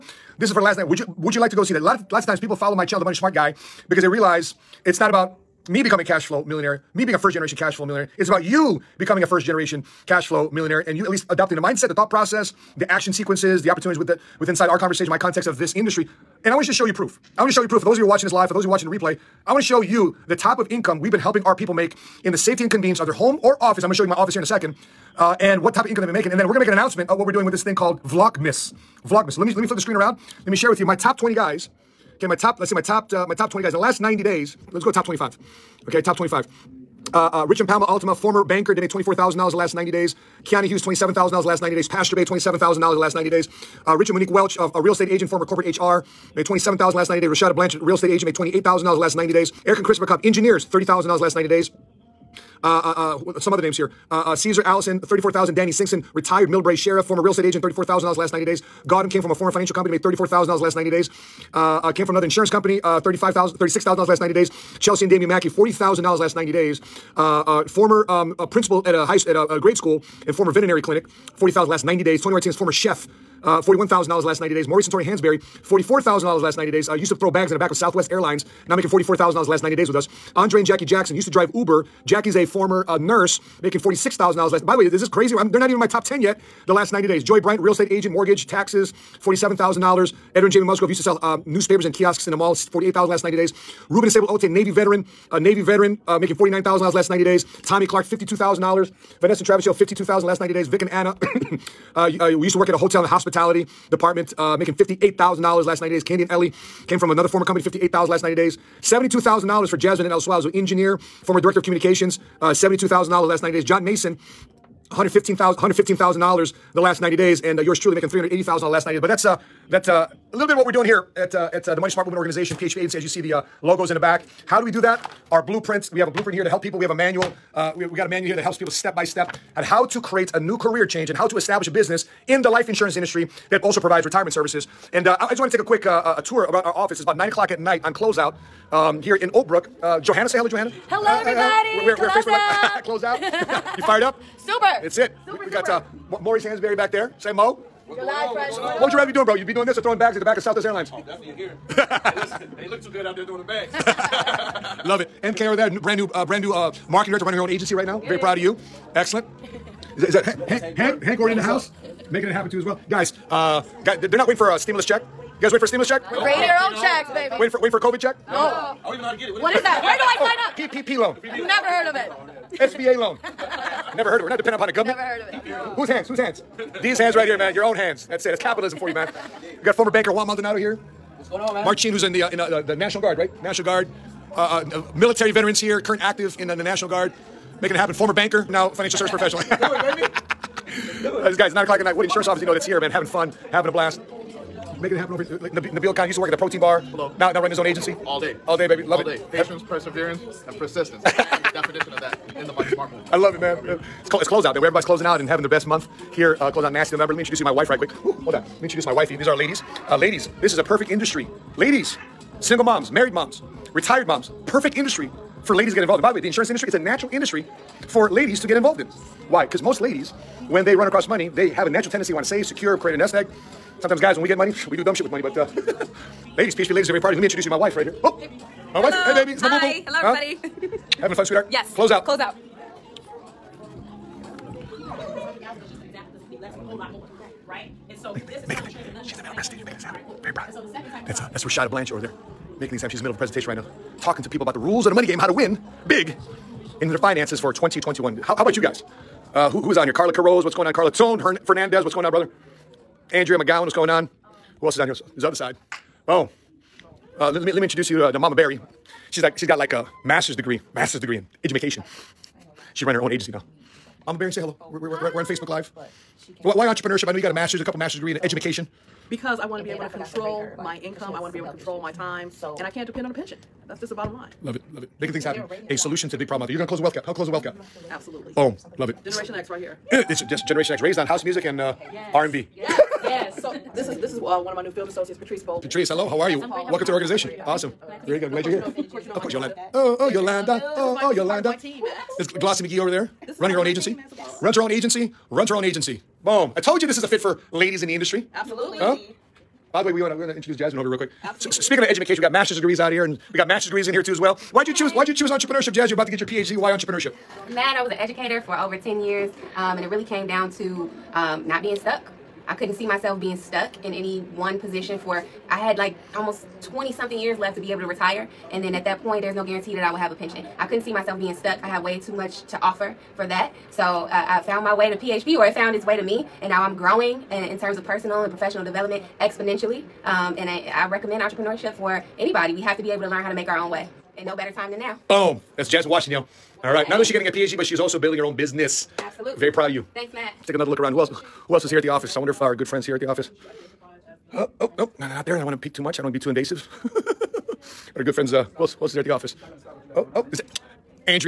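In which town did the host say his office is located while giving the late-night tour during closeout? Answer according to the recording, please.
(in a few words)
Oak Brook.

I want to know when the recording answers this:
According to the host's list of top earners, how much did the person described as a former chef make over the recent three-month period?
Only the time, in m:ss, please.
1:13.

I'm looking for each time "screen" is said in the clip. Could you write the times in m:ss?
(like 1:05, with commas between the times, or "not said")
0:29.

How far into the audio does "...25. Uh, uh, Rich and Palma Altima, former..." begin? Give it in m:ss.
0:36.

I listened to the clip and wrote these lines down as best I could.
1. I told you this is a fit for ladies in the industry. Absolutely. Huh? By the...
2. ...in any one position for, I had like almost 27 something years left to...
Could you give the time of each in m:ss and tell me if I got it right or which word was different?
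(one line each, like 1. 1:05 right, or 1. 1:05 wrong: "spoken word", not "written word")
1. 4:56 right
2. 5:13 wrong: "20", not "27".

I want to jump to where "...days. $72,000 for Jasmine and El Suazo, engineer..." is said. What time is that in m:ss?
1:48.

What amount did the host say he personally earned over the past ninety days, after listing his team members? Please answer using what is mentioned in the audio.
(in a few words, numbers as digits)
$380,000.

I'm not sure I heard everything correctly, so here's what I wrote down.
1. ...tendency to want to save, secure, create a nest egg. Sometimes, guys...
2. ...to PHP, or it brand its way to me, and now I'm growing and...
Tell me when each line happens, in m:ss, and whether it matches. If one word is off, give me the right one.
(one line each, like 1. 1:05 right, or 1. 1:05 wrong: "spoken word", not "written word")
1. 3:41 right
2. 5:24 wrong: "found", not "brand".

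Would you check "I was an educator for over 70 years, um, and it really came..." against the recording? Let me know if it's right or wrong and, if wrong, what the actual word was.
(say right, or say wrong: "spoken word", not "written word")
wrong: "10", not "70".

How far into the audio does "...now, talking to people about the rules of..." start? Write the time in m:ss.
4:03.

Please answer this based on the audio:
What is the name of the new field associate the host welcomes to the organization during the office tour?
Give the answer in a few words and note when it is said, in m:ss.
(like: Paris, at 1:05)
Patrice Bold, at 4:45.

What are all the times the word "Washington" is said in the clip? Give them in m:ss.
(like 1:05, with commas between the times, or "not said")
5:35.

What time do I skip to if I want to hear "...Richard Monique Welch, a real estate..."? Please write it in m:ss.
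0:43.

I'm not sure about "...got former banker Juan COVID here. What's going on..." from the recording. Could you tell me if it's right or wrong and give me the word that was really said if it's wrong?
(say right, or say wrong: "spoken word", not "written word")
wrong: "Maldonado", not "COVID".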